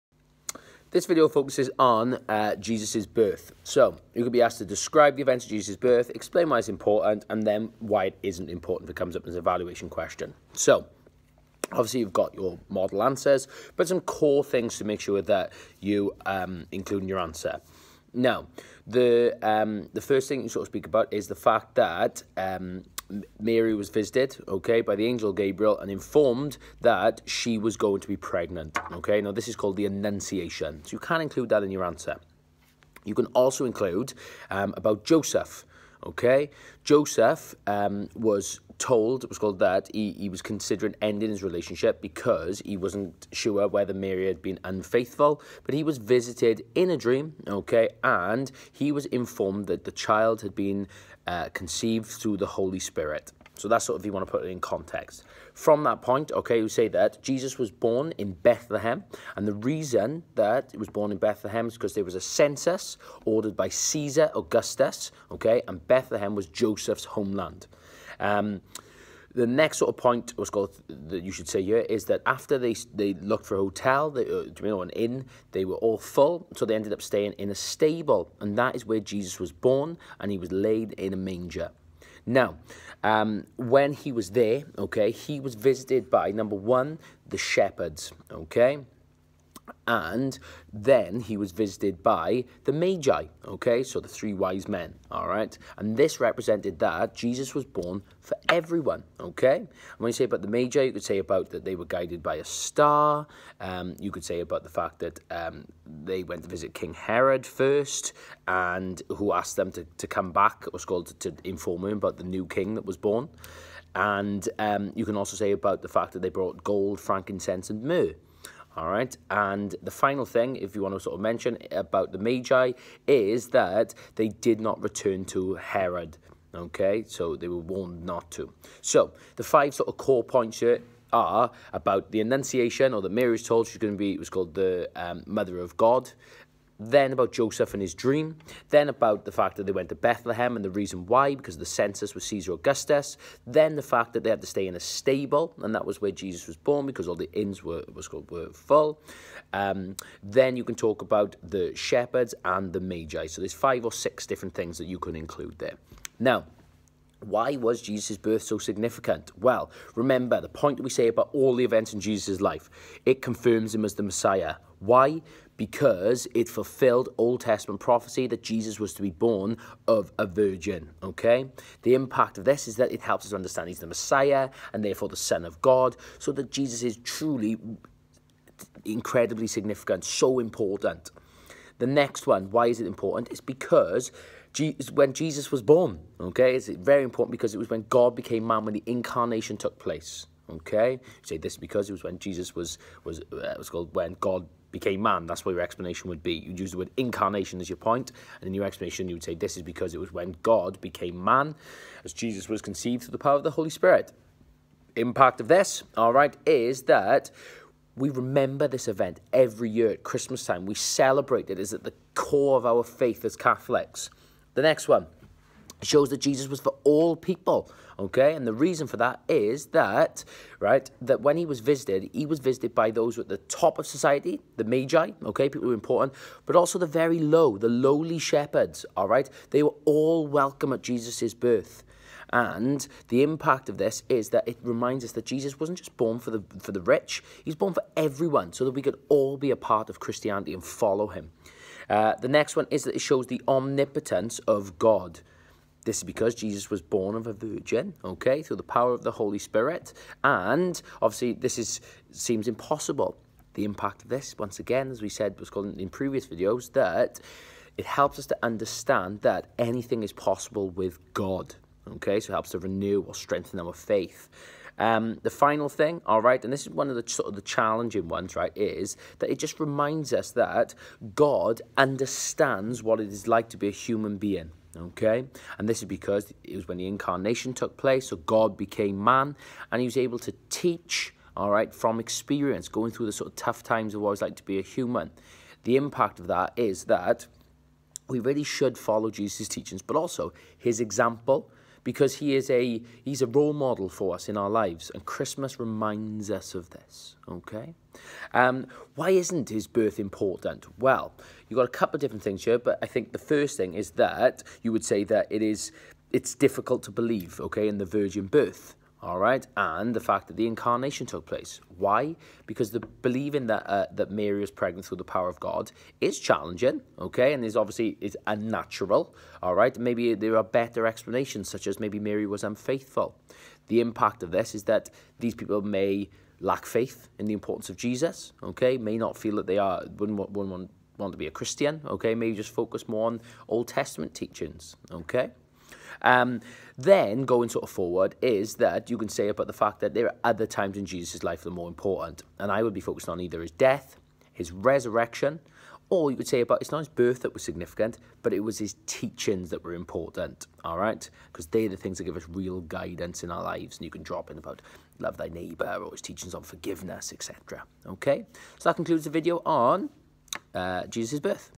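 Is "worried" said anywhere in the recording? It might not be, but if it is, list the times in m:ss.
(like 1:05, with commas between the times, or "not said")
not said.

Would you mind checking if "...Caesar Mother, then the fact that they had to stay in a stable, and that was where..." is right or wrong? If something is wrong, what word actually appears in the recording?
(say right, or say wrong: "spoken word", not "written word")
wrong: "Augustus", not "Mother".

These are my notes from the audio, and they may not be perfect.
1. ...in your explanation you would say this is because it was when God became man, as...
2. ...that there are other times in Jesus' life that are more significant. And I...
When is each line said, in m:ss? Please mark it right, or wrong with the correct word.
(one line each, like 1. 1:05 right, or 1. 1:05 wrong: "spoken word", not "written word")
1. 3:18 right
2. 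5:39 wrong: "important", not "significant".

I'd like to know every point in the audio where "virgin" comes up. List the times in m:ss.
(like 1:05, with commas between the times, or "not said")
2:50, 4:07, 5:07.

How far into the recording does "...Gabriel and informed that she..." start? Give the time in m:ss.
0:25.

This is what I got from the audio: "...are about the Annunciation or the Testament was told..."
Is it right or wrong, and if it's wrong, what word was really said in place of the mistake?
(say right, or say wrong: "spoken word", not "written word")
wrong: "Mary", not "Testament".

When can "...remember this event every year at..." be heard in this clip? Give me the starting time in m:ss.
3:28.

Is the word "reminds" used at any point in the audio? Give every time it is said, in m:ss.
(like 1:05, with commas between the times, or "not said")
3:54, 4:29, 4:55.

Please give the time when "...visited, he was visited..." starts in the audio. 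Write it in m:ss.
3:41.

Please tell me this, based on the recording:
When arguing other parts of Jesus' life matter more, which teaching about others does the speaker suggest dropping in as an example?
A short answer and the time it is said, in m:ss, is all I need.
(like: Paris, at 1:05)
Love thy neighbour, at 5:54.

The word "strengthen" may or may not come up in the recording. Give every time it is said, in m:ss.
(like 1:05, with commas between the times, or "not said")
4:23.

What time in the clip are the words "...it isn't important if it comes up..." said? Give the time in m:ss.
0:08.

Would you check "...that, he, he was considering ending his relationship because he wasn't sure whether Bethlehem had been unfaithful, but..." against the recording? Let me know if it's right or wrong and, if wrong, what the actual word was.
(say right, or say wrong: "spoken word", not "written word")
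wrong: "Mary", not "Bethlehem".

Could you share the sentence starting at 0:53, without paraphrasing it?
So that's sort of, if you want to put it in context.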